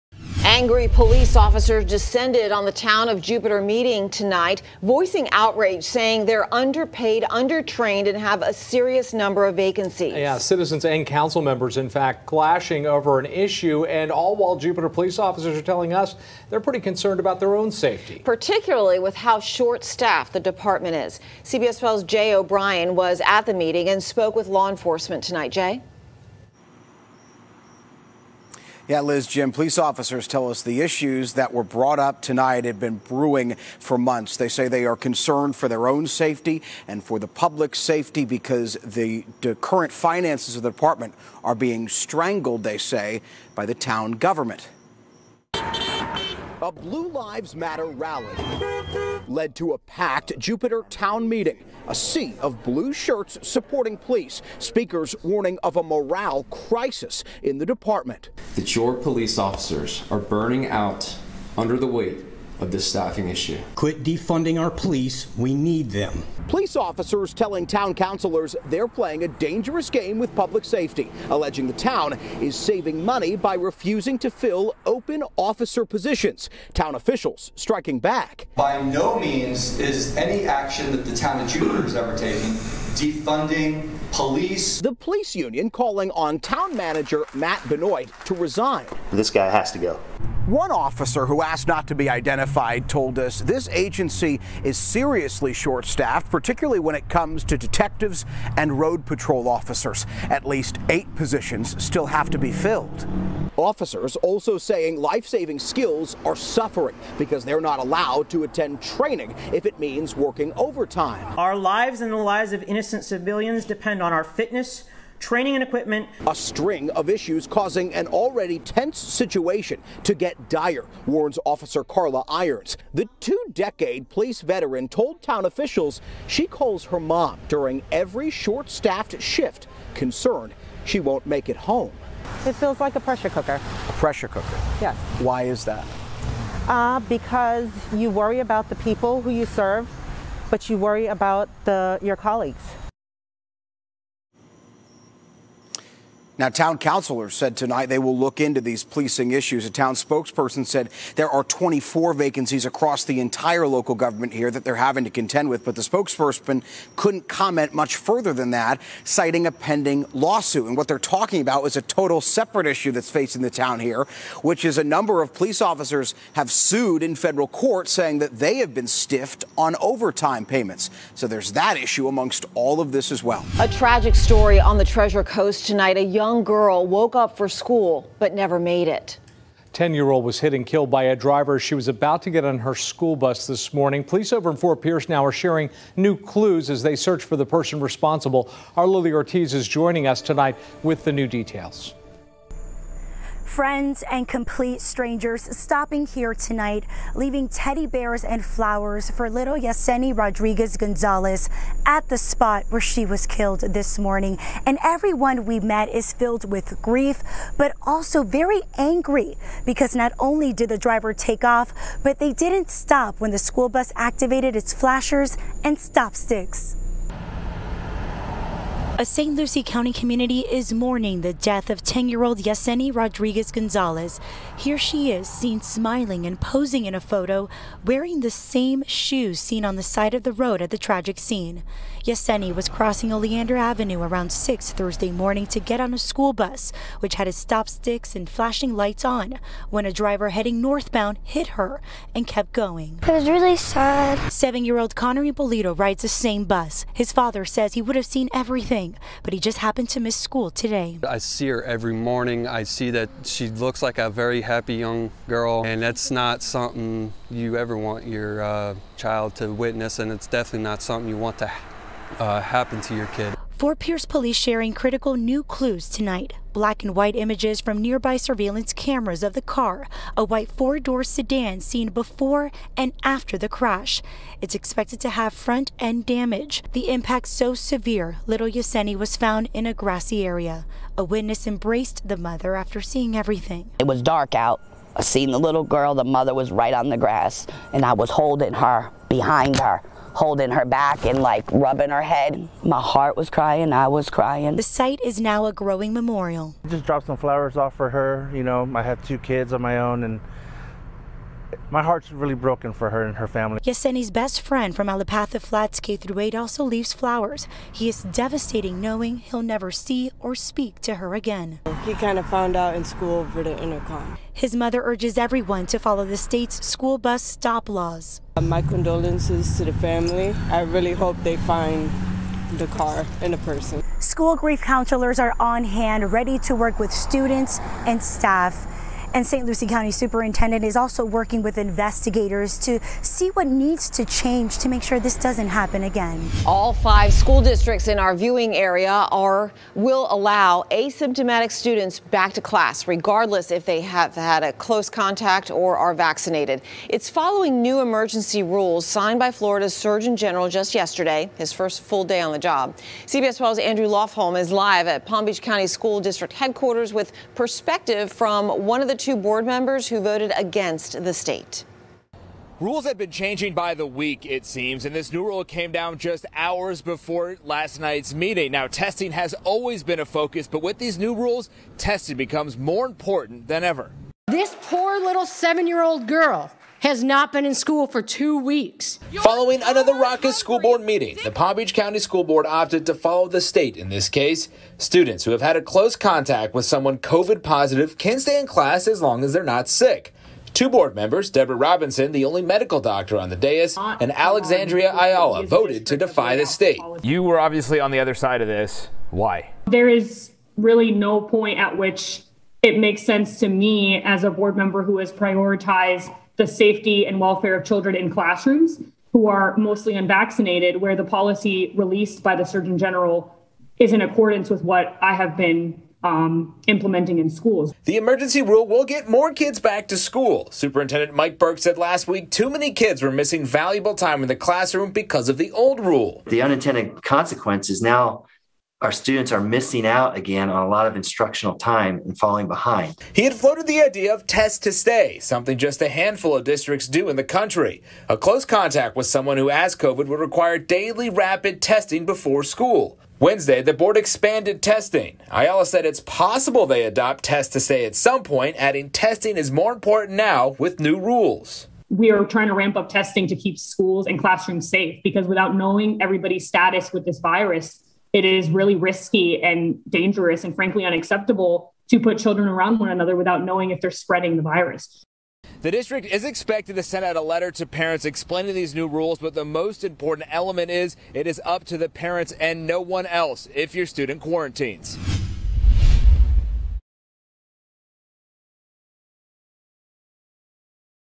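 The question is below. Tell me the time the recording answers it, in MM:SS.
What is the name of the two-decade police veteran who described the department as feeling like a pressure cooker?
02:01.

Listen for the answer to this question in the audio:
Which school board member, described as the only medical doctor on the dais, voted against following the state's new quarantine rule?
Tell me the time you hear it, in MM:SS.
06:31.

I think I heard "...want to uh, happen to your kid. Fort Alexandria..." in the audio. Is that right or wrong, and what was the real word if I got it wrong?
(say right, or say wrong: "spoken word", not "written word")
wrong: "Pierce", not "Alexandria".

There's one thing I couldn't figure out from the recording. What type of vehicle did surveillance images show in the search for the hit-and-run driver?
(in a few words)
white four-door sedan.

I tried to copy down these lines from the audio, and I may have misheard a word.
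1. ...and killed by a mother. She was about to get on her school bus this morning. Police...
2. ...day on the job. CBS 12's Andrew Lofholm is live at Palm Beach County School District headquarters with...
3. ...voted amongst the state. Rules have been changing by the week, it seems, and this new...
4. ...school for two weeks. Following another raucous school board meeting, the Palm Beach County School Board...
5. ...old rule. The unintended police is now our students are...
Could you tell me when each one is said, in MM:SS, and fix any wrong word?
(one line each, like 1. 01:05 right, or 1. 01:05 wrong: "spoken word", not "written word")
1. 03:00 wrong: "driver", not "mother"
2. 05:52 right
3. 05:59 wrong: "against", not "amongst"
4. 06:17 right
5. 07:05 wrong: "consequence", not "police".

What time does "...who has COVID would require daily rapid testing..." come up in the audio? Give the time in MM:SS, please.
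07:19.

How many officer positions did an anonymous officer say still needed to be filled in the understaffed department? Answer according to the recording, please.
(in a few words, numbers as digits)
8.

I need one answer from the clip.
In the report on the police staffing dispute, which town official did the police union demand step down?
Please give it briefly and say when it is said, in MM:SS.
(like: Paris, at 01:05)
Matt Benoit, at 01:27.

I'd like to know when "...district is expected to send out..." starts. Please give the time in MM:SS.
07:45.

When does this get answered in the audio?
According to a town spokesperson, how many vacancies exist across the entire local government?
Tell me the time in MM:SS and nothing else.
02:31.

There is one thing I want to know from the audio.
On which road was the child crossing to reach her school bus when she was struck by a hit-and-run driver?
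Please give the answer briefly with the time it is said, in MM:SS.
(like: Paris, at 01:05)
Oleander Avenue, at 03:53.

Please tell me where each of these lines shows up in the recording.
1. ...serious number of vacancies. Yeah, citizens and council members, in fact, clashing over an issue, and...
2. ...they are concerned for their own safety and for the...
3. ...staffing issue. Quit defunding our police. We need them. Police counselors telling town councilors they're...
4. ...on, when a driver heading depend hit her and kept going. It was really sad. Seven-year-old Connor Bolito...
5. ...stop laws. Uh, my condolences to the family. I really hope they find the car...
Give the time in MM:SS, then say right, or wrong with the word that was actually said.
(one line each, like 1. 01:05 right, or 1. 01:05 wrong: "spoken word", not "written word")
1. 00:08 right
2. 00:34 right
3. 01:02 wrong: "officers", not "counselors"
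4. 03:59 wrong: "northbound", not "depend"
5. 05:17 right.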